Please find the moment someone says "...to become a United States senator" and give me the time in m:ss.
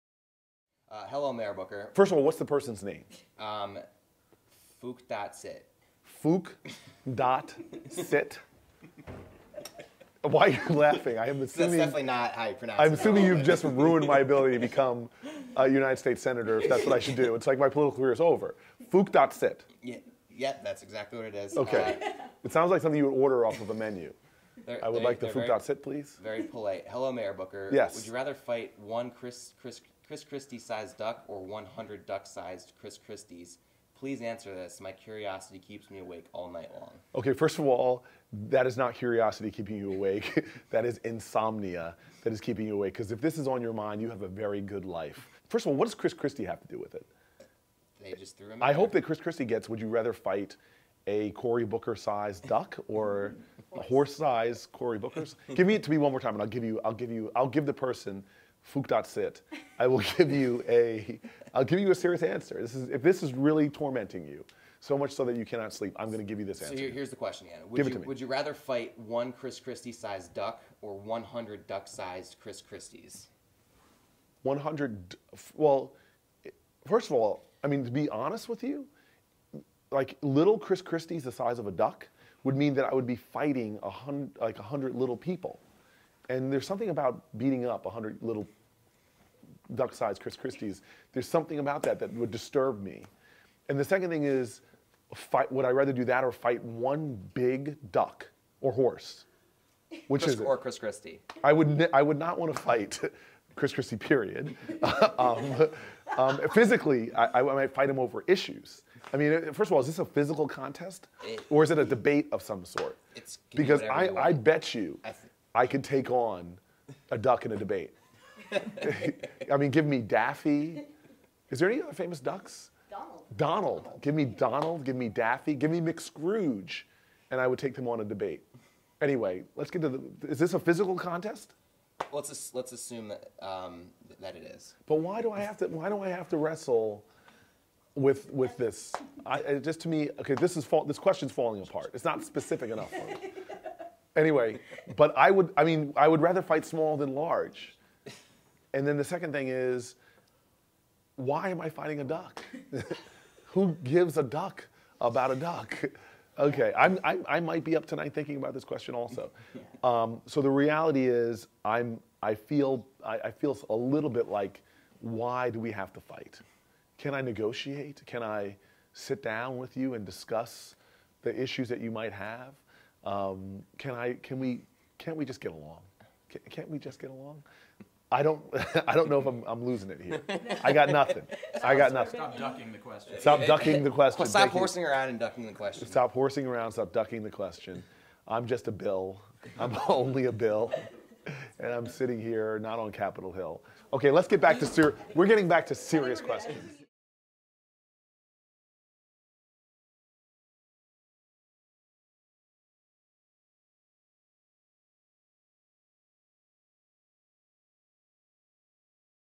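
0:14.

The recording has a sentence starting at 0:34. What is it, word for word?
My curiosity keeps me awake all night long.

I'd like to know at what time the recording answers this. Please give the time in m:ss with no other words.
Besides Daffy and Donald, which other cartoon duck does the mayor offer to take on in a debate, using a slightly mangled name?
2:05.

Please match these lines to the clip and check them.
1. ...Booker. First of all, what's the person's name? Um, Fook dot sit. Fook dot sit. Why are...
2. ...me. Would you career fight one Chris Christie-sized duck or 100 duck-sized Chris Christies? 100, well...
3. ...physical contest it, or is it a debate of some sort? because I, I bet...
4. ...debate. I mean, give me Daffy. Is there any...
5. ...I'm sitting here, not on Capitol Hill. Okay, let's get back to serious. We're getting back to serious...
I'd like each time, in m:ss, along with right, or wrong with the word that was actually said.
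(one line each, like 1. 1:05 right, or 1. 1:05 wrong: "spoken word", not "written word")
1. 0:01 right
2. 1:08 wrong: "rather", not "career"
3. 1:50 right
4. 1:57 right
5. 3:11 right.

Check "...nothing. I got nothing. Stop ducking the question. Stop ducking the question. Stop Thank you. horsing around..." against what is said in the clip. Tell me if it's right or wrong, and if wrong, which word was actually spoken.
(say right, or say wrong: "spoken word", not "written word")
right.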